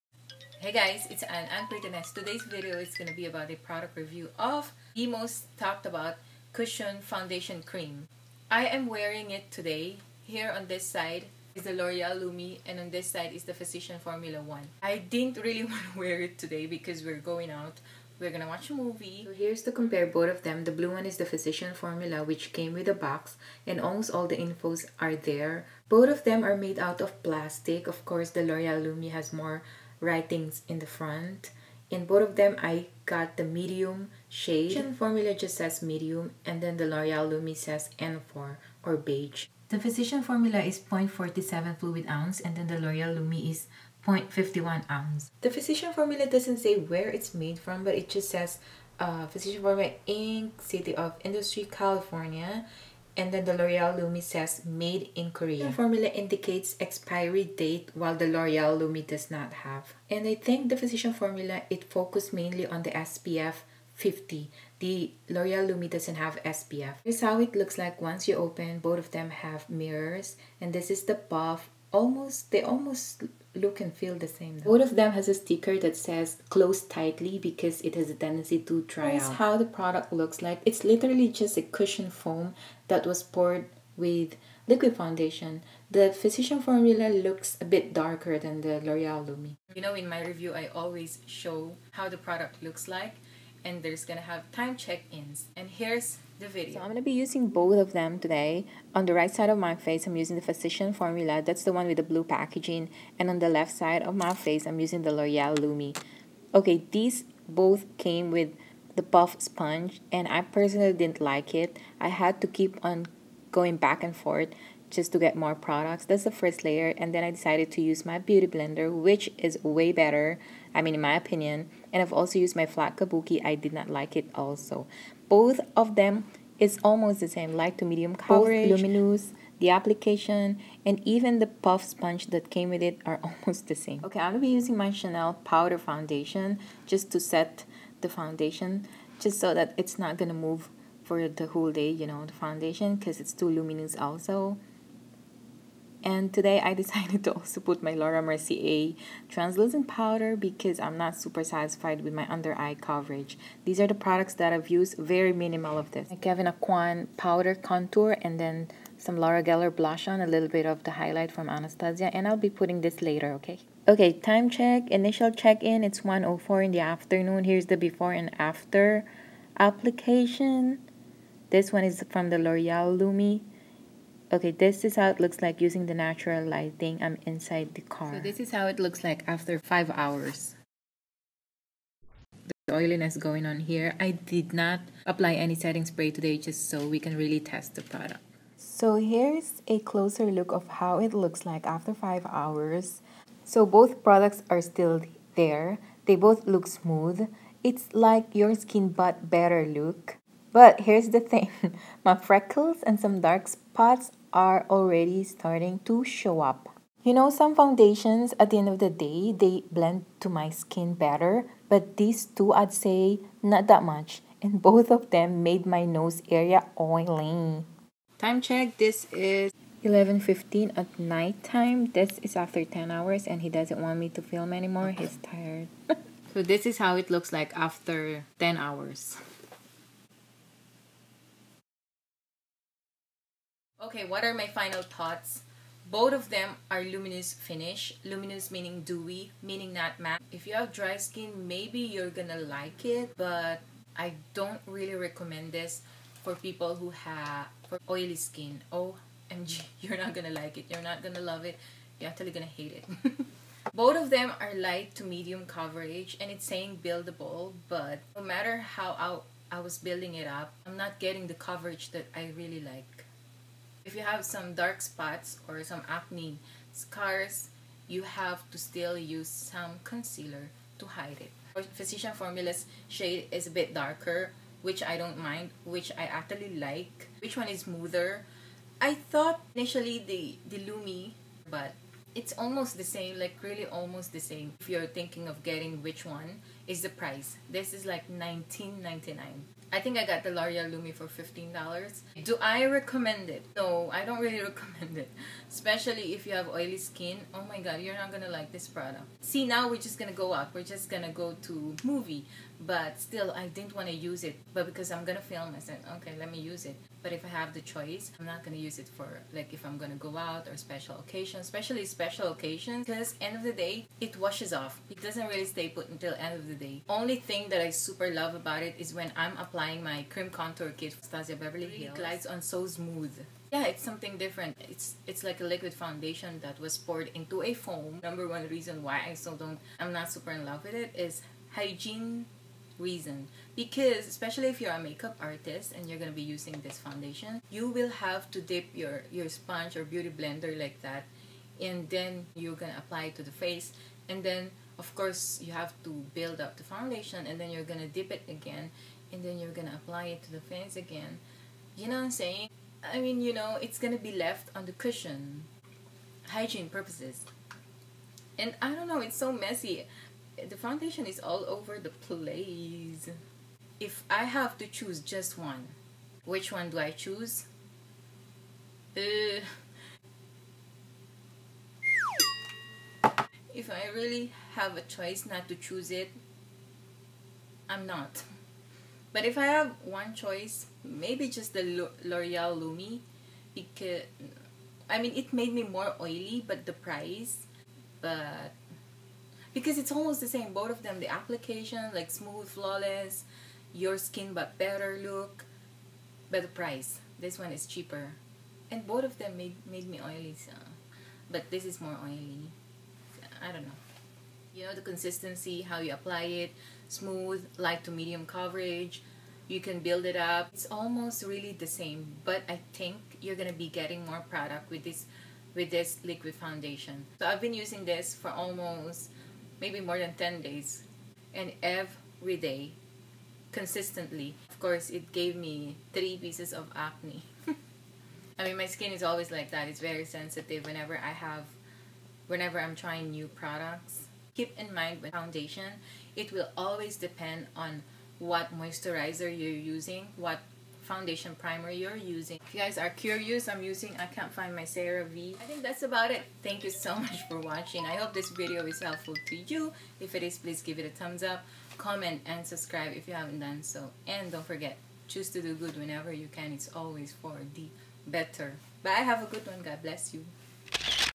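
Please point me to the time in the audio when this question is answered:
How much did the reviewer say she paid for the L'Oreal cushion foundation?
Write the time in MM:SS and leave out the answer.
04:51.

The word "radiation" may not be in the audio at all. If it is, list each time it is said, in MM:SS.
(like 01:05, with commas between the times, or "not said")
not said.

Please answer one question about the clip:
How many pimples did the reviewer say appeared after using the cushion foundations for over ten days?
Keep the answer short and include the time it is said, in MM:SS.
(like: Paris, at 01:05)
3, at 07:05.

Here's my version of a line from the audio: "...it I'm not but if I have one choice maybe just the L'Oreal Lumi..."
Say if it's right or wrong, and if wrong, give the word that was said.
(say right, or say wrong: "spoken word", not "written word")
right.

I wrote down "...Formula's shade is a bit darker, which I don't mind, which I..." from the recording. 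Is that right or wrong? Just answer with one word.
right.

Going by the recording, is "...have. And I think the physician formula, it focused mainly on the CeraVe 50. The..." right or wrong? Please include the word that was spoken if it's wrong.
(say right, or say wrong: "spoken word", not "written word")
wrong: "SPF", not "CeraVe".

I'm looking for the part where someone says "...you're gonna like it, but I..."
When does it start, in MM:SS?
04:01.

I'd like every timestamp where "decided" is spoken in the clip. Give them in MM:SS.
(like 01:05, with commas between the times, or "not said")
01:57, 02:26.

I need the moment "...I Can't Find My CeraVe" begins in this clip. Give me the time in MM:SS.
07:23.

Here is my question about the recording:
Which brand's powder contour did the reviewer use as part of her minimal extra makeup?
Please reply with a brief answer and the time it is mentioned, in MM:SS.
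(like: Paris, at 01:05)
Kevyn Aucoin, at 02:36.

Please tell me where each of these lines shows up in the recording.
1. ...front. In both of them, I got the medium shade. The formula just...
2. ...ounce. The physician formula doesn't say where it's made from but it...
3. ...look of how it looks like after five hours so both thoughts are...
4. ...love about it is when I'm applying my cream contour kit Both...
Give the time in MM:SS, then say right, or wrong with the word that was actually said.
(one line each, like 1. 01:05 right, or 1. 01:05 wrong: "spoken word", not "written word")
1. 00:30 right
2. 00:44 right
3. 03:10 wrong: "products", not "thoughts"
4. 05:18 wrong: "Anastasia", not "Both".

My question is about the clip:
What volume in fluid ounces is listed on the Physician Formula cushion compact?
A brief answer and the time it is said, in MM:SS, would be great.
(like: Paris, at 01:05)
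0.47, at 00:40.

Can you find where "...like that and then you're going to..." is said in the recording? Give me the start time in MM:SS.
05:40.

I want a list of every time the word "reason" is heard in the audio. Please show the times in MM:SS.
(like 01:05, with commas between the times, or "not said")
05:28, 05:32.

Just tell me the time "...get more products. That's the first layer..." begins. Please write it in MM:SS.
01:55.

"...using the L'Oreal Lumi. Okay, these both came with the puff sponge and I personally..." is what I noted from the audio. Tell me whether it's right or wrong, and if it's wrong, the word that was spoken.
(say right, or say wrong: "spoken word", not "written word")
right.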